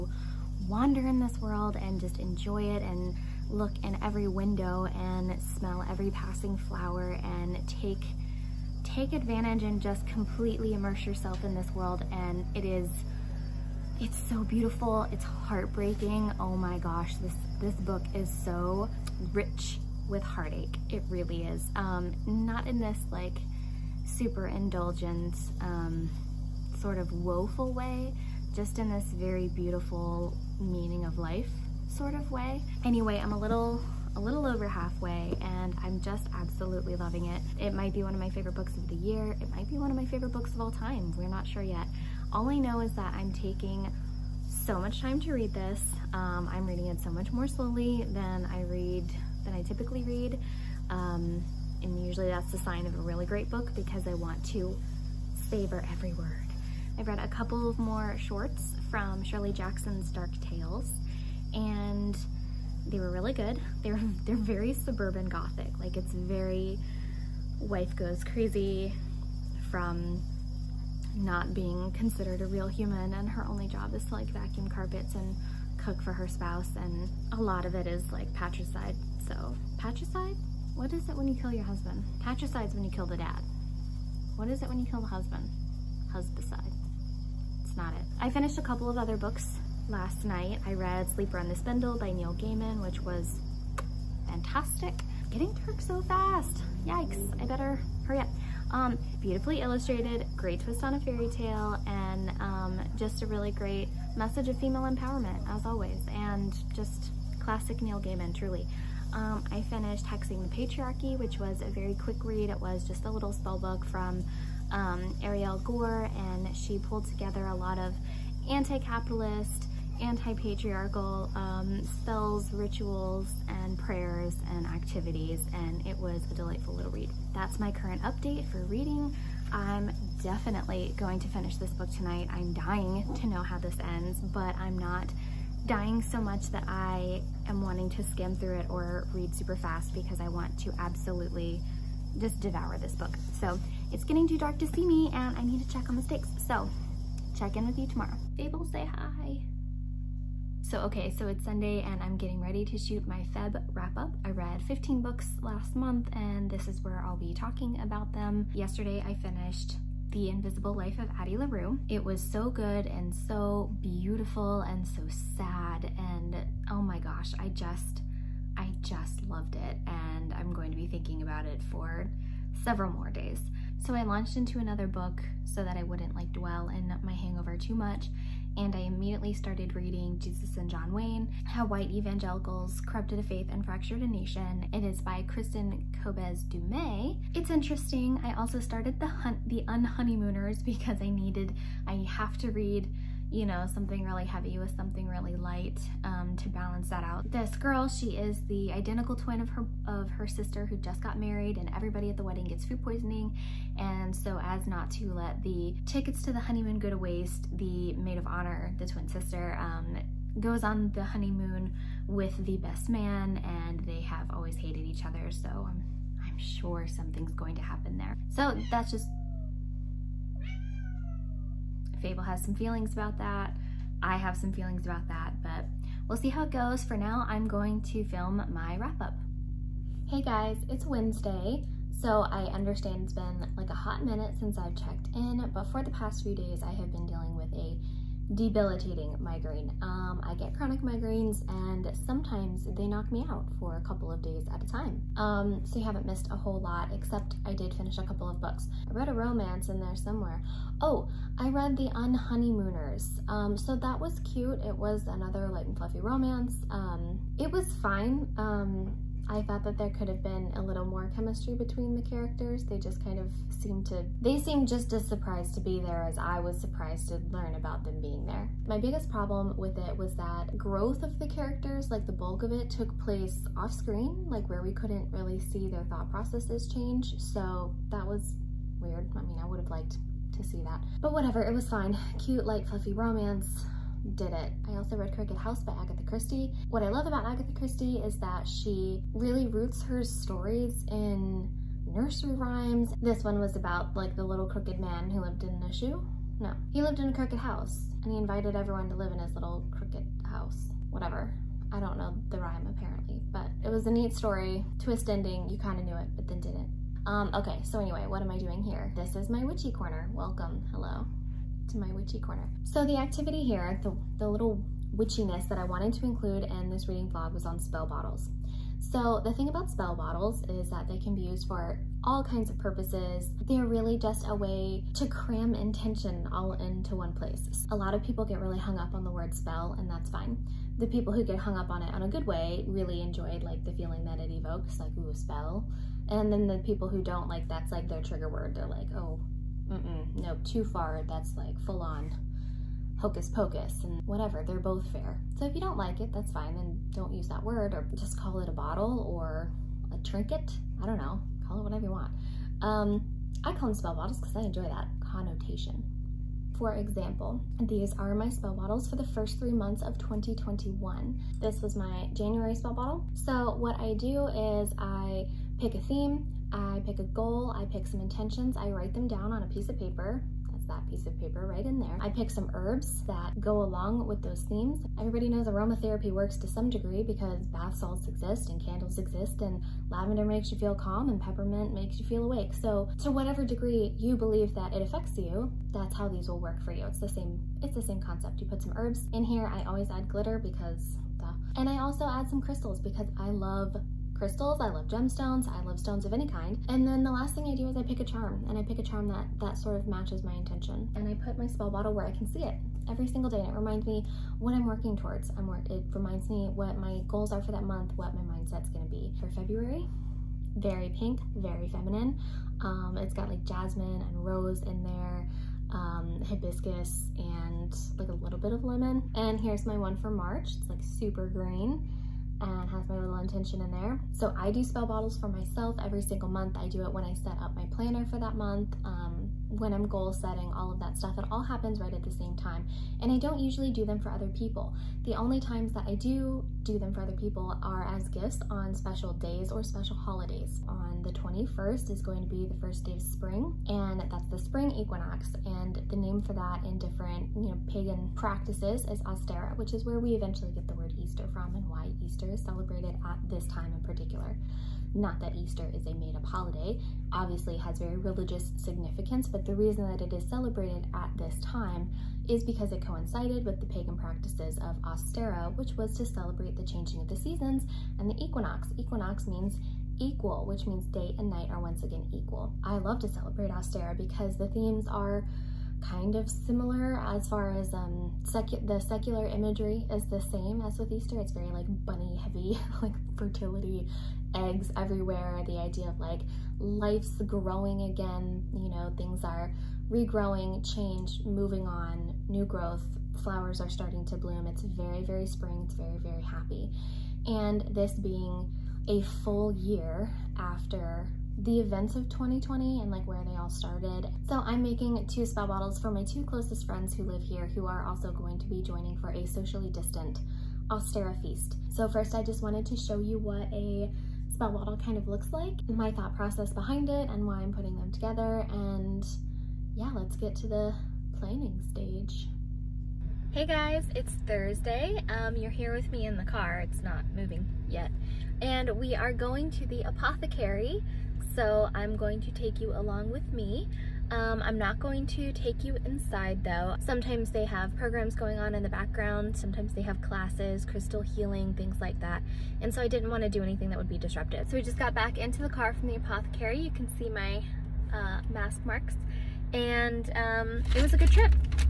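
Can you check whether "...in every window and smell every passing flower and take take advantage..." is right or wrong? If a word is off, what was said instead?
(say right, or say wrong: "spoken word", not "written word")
right.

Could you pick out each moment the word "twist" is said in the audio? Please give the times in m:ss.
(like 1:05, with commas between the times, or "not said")
1:40, 5:04.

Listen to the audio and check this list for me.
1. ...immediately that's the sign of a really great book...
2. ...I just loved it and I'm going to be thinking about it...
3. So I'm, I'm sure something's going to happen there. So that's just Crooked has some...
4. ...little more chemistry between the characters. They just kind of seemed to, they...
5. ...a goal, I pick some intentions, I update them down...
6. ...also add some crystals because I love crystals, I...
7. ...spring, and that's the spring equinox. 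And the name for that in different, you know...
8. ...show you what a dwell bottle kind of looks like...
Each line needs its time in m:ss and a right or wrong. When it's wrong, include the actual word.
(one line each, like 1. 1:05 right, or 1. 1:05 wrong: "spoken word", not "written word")
1. 0:52 wrong: "usually", not "immediately"
2. 2:48 right
3. 3:35 wrong: "Fable", not "Crooked"
4. 4:20 right
5. 6:06 wrong: "write", not "update"
6. 6:31 right
7. 7:23 right
8. 8:32 wrong: "spell", not "dwell".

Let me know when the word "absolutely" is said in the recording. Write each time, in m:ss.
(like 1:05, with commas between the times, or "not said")
0:36, 2:20.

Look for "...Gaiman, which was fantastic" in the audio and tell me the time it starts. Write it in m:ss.
1:32.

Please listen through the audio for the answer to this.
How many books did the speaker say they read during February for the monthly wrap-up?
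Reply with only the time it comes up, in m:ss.
2:34.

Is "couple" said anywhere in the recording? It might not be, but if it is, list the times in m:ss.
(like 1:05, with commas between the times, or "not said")
0:57, 1:28, 4:03, 4:08.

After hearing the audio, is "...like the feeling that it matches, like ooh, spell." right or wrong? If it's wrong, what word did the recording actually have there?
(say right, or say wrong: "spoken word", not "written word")
wrong: "evokes", not "matches".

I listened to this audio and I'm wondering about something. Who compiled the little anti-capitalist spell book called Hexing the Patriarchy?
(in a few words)
Ariel Gore.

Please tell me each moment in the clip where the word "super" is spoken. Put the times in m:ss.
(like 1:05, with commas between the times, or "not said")
0:24, 2:19, 7:00.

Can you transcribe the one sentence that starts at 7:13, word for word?
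And I don't usually do them for other people.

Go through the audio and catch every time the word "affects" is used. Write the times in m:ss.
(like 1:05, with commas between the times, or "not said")
6:24.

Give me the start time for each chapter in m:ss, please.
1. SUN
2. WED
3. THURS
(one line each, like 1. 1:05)
1. 2:28
2. 3:48
3. 8:42.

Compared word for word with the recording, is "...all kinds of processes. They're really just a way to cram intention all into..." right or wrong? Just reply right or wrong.
wrong.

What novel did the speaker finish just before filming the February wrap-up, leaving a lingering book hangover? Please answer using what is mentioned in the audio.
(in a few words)
The Invisible Life of Addie LaRue.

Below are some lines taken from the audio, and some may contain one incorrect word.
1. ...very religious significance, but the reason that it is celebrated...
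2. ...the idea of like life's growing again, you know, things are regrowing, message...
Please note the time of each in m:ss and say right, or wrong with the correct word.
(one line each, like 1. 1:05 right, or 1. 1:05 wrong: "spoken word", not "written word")
1. 7:37 right
2. 8:05 wrong: "change", not "message".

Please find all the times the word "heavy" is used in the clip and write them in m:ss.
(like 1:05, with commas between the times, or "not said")
3:14, 8:02.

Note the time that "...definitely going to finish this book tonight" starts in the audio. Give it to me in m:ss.
2:10.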